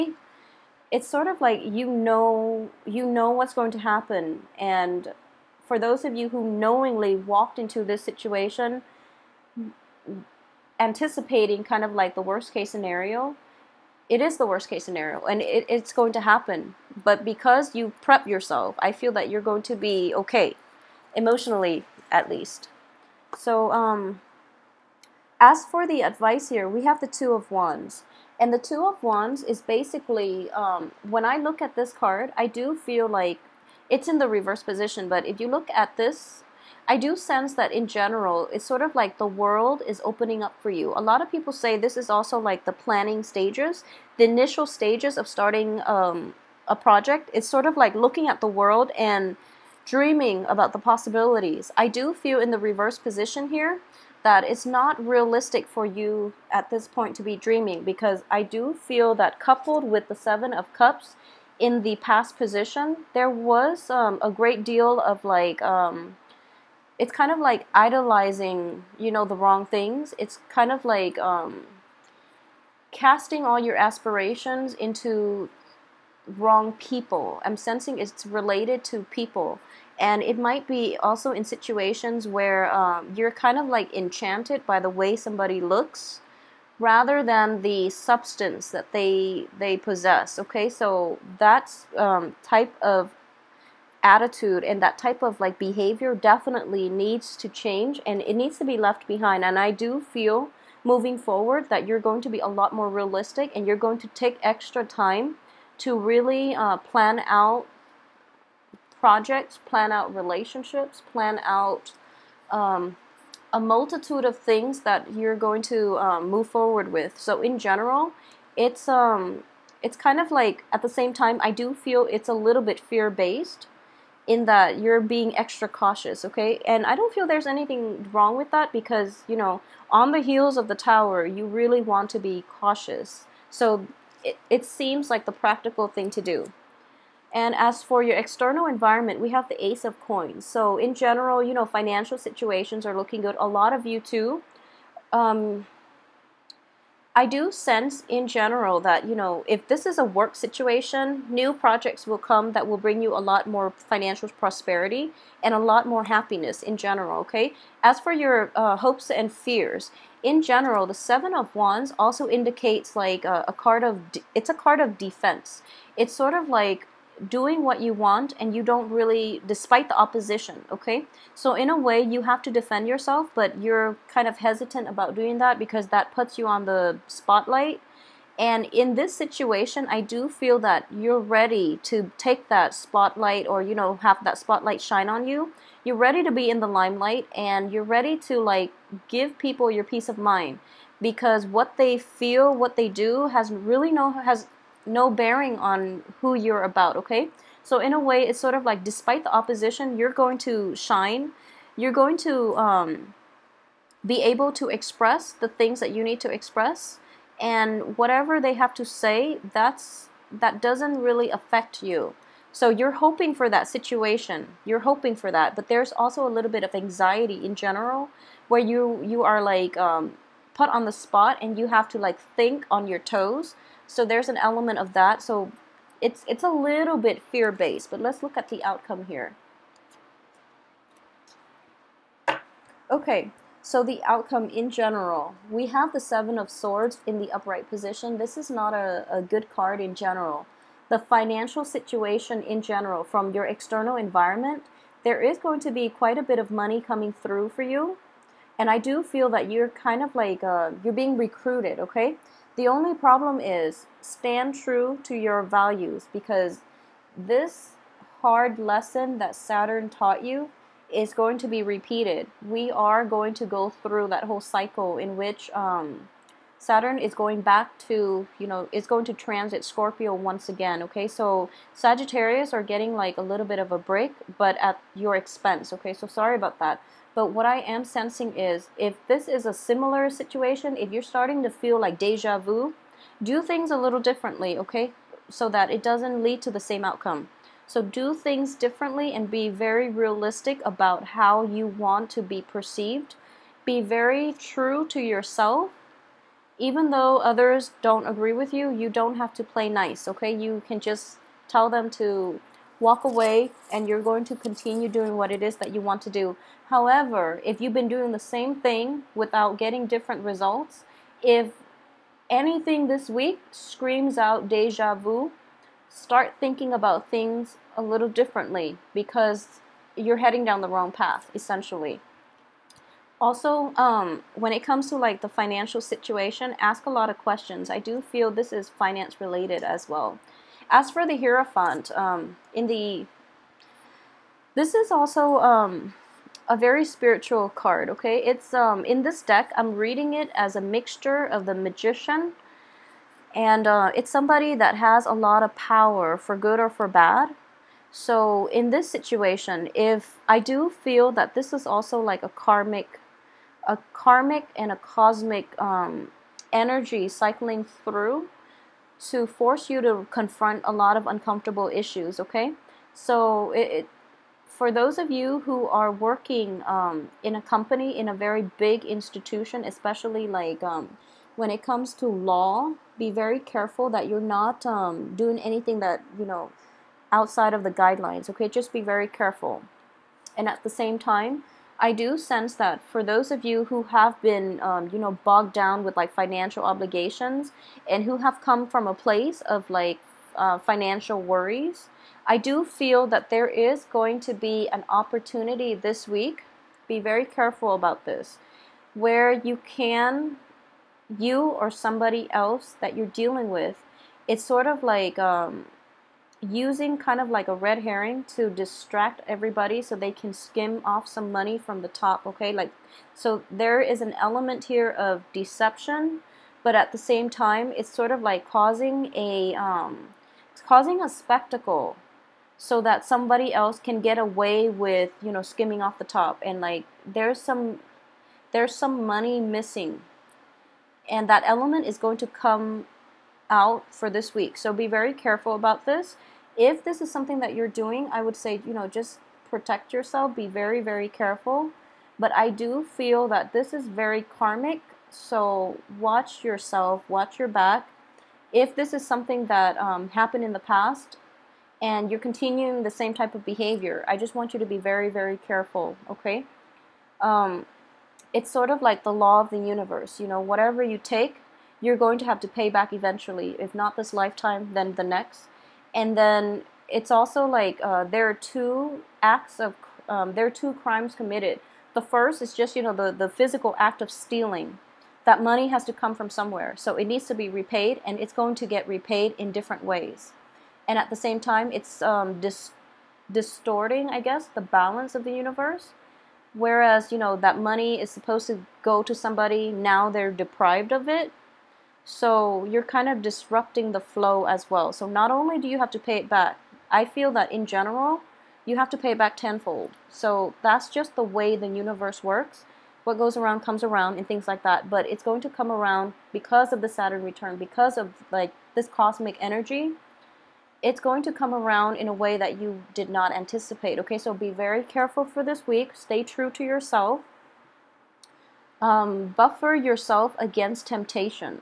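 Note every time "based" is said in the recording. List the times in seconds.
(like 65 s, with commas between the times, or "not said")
123 s, 227 s.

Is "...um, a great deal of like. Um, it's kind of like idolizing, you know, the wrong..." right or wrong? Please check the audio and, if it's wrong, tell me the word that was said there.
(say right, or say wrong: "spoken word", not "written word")
right.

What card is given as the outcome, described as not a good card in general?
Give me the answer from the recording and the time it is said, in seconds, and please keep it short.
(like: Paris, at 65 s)
Seven of Swords, at 236 s.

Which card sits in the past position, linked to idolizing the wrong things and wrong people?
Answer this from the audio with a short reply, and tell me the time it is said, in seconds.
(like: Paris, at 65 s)
Seven of Cups, at 60 s.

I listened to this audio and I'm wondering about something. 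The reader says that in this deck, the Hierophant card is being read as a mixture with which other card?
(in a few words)
the Magician.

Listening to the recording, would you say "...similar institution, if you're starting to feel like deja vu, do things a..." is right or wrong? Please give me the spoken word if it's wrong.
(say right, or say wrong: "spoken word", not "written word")
wrong: "situation", not "institution".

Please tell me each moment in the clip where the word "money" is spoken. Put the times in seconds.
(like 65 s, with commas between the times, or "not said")
246 s, 411 s, 429 s, 475 s, 487 s.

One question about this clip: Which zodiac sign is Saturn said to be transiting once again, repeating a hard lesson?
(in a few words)
Scorpio.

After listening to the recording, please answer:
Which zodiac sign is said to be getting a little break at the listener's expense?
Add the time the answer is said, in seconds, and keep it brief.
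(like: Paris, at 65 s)
Sagittarius, at 271 s.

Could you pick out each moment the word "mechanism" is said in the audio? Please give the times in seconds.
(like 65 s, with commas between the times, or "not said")
not said.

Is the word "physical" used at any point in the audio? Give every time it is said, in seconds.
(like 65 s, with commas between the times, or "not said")
473 s.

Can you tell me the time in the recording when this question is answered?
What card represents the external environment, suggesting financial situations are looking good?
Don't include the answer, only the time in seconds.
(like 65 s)
139 s.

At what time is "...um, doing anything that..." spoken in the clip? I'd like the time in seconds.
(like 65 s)
374 s.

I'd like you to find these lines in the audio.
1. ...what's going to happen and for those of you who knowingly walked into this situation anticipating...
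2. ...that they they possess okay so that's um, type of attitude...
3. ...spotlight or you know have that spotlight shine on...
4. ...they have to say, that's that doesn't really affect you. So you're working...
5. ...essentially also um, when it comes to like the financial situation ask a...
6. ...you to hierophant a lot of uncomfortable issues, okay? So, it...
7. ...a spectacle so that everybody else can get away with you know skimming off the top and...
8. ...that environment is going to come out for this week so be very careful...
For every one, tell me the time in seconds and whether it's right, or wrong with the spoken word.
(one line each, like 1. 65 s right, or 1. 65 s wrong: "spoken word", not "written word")
1. 3 s right
2. 88 s right
3. 182 s right
4. 208 s wrong: "hoping", not "working"
5. 321 s right
6. 359 s wrong: "confront", not "hierophant"
7. 421 s wrong: "somebody", not "everybody"
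8. 431 s wrong: "element", not "environment".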